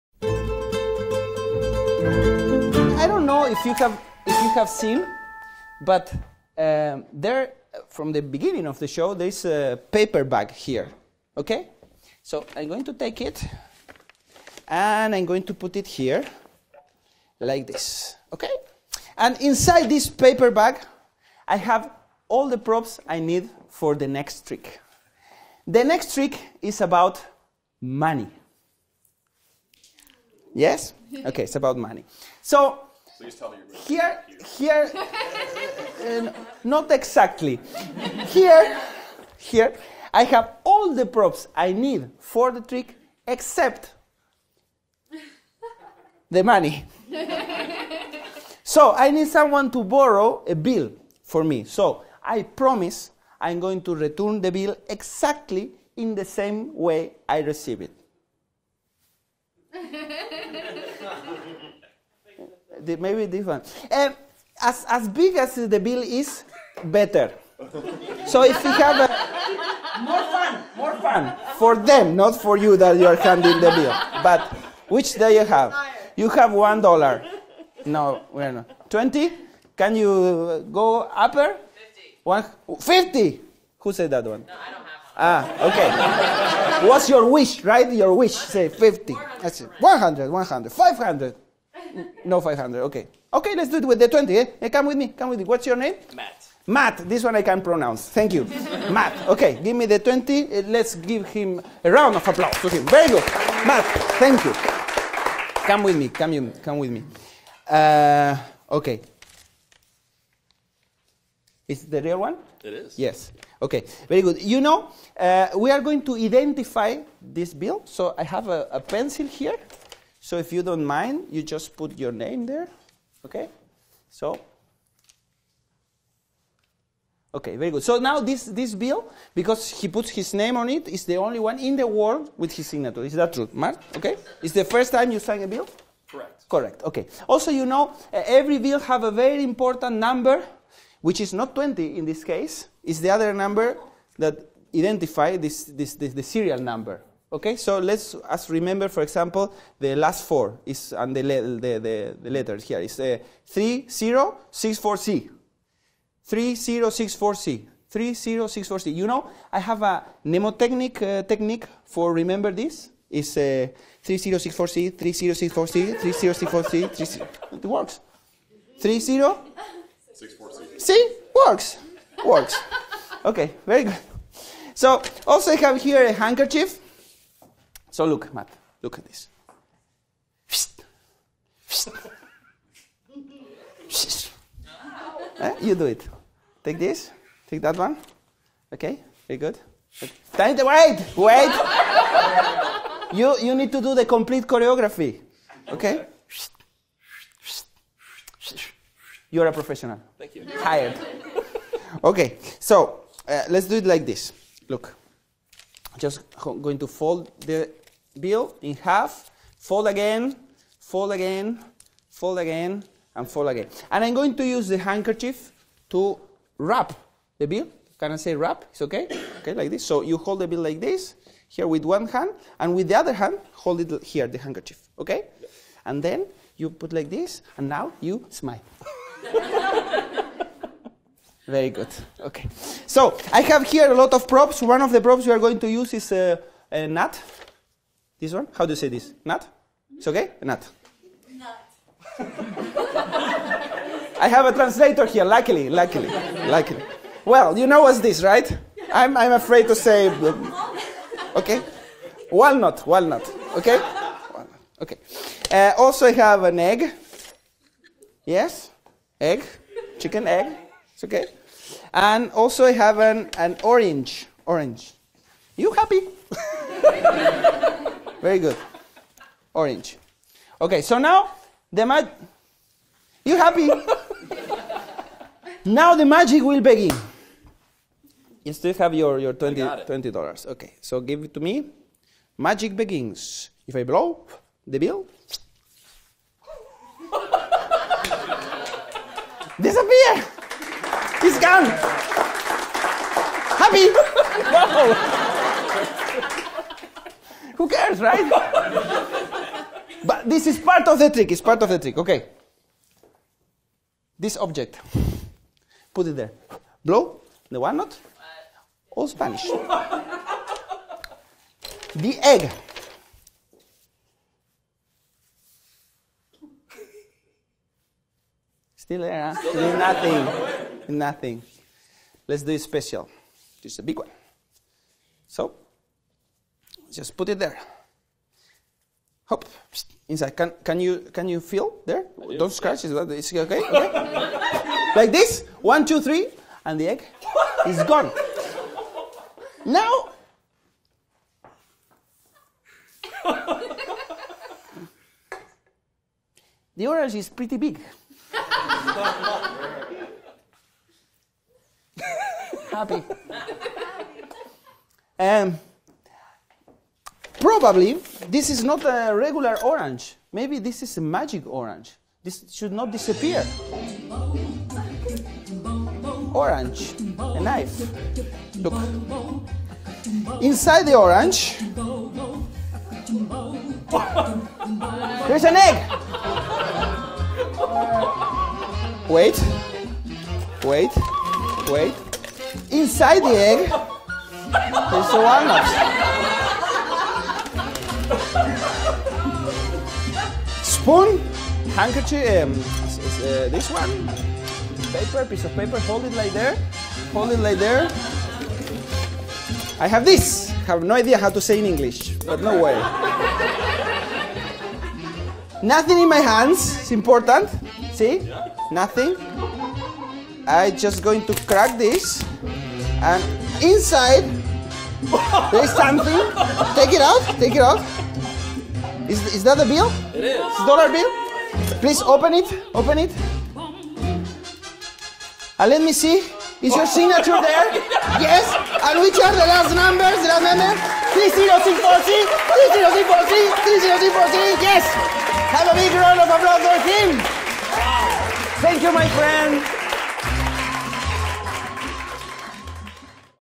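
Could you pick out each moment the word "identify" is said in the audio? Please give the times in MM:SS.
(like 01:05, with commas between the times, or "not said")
01:56, 02:24.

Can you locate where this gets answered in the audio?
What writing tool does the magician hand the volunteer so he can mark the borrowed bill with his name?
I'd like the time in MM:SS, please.
01:58.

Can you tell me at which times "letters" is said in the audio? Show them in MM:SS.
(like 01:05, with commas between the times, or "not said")
02:32.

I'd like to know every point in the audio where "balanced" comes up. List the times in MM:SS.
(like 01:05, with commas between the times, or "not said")
not said.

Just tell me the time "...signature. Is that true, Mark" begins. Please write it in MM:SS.
02:12.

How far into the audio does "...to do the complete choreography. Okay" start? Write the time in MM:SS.
03:13.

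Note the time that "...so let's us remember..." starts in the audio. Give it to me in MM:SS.
02:27.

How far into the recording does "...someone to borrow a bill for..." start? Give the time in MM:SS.
00:49.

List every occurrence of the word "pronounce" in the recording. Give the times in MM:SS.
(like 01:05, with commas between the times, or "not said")
01:37.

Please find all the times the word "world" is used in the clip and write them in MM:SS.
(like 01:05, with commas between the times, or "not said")
02:11.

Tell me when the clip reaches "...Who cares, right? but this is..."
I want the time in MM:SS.
04:57.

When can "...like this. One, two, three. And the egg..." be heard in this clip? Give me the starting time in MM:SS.
05:34.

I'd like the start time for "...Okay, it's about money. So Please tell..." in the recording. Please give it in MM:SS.
00:31.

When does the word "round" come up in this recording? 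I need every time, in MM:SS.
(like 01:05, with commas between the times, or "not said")
01:41, 07:15.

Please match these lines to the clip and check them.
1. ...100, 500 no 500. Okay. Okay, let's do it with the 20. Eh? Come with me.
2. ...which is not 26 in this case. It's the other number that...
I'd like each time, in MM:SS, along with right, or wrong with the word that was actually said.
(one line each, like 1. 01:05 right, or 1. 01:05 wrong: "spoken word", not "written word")
1. 01:30 right
2. 02:21 wrong: "20", not "26".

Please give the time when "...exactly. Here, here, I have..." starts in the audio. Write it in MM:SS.
00:36.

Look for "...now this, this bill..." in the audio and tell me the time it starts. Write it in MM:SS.
02:07.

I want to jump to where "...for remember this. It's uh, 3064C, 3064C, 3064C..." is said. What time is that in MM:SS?
02:41.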